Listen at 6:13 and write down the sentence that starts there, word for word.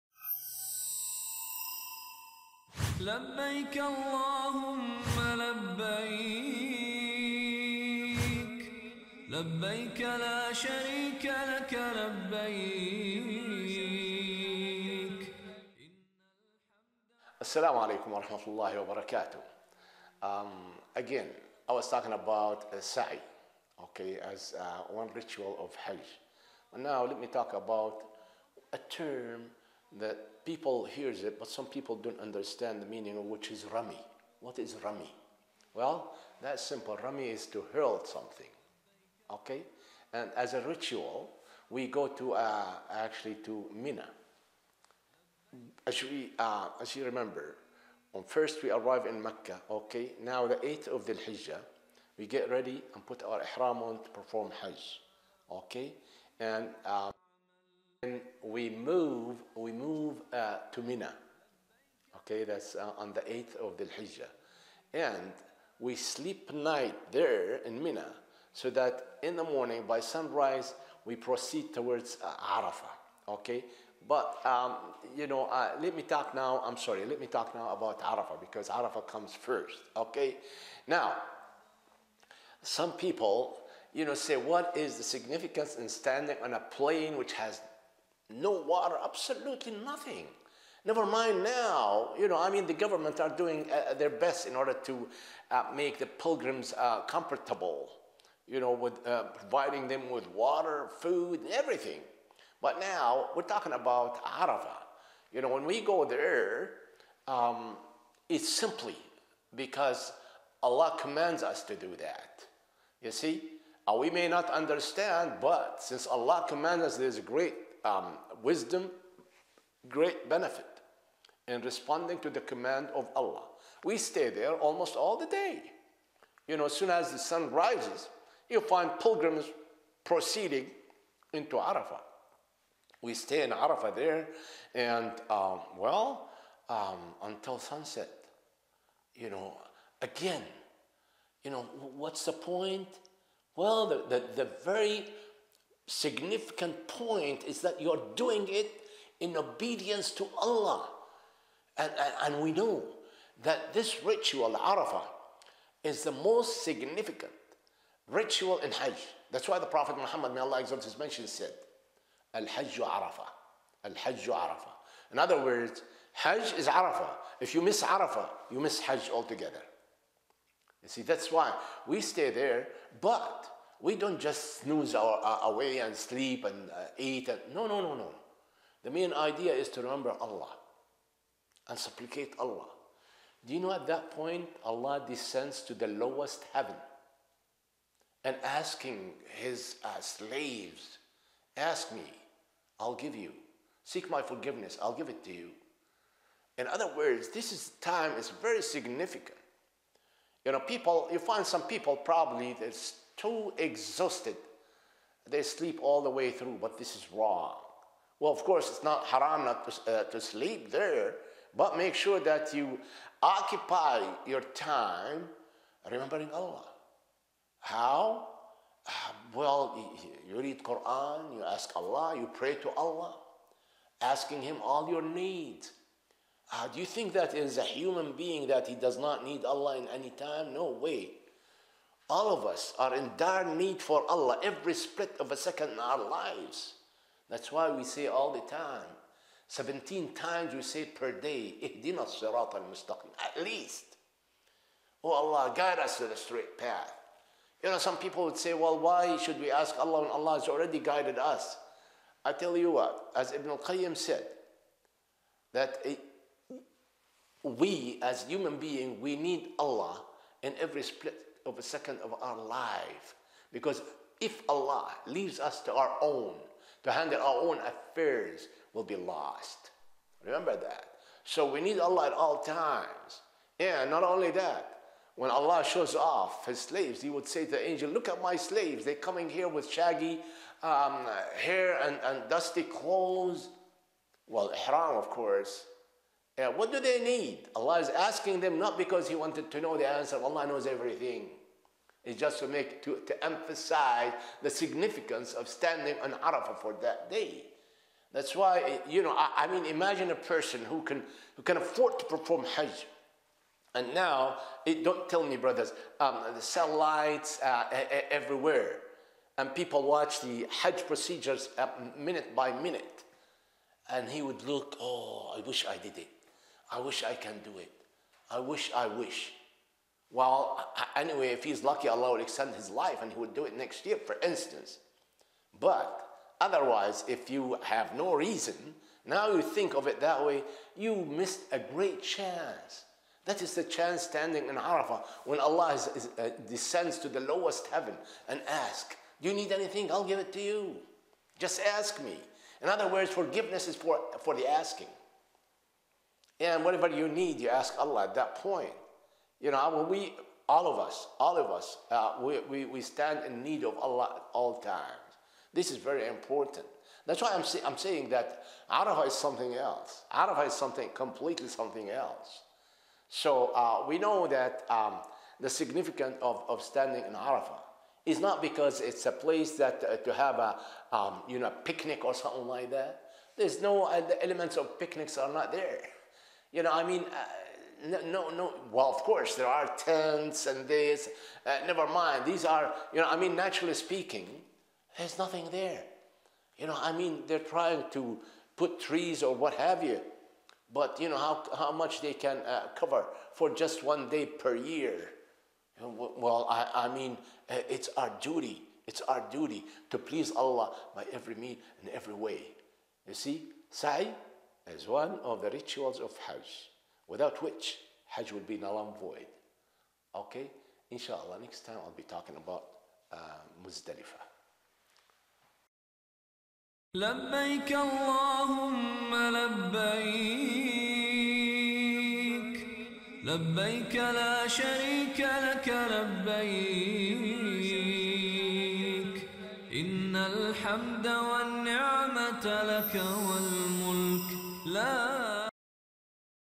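There's no uh, the elements of picnics are not there.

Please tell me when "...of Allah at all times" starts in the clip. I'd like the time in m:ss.
5:53.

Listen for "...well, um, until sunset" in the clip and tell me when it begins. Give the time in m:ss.
2:15.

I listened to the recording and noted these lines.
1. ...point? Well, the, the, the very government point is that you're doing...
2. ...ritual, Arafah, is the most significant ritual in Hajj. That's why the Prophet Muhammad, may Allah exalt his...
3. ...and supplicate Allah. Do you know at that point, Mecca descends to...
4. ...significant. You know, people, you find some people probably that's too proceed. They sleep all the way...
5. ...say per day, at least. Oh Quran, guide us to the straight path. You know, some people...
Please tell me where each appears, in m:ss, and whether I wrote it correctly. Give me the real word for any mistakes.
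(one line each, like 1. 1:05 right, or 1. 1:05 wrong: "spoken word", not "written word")
1. 2:22 wrong: "significant", not "government"
2. 2:34 right
3. 3:01 wrong: "Allah", not "Mecca"
4. 3:18 wrong: "exhausted", not "proceed"
5. 4:00 wrong: "Allah", not "Quran".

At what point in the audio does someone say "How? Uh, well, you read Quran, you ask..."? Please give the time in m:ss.
3:37.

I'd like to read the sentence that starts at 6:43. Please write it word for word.
You see, sa'i as one of the rituals of Hajj, without which Hajj would be null and void.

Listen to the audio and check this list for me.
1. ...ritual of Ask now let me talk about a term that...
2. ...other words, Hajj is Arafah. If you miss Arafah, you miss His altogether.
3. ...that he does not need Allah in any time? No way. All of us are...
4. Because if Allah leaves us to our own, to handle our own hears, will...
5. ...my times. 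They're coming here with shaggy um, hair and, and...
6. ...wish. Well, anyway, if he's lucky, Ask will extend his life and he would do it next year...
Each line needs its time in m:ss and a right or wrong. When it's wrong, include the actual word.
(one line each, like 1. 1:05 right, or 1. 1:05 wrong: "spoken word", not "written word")
1. 0:25 wrong: "Hajj", not "Ask"
2. 2:45 wrong: "Hajj", not "His"
3. 3:48 right
4. 4:23 wrong: "affairs", not "hears"
5. 4:38 wrong: "slaves", not "times"
6. 5:18 wrong: "Allah", not "Ask".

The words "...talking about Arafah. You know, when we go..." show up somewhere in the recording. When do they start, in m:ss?
1:43.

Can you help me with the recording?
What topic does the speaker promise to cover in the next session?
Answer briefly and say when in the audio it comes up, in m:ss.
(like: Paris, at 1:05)
Muzdalifah, at 6:53.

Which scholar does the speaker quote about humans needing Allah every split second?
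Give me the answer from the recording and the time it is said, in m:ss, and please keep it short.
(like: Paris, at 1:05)
Ibn al-Qayyim, at 4:13.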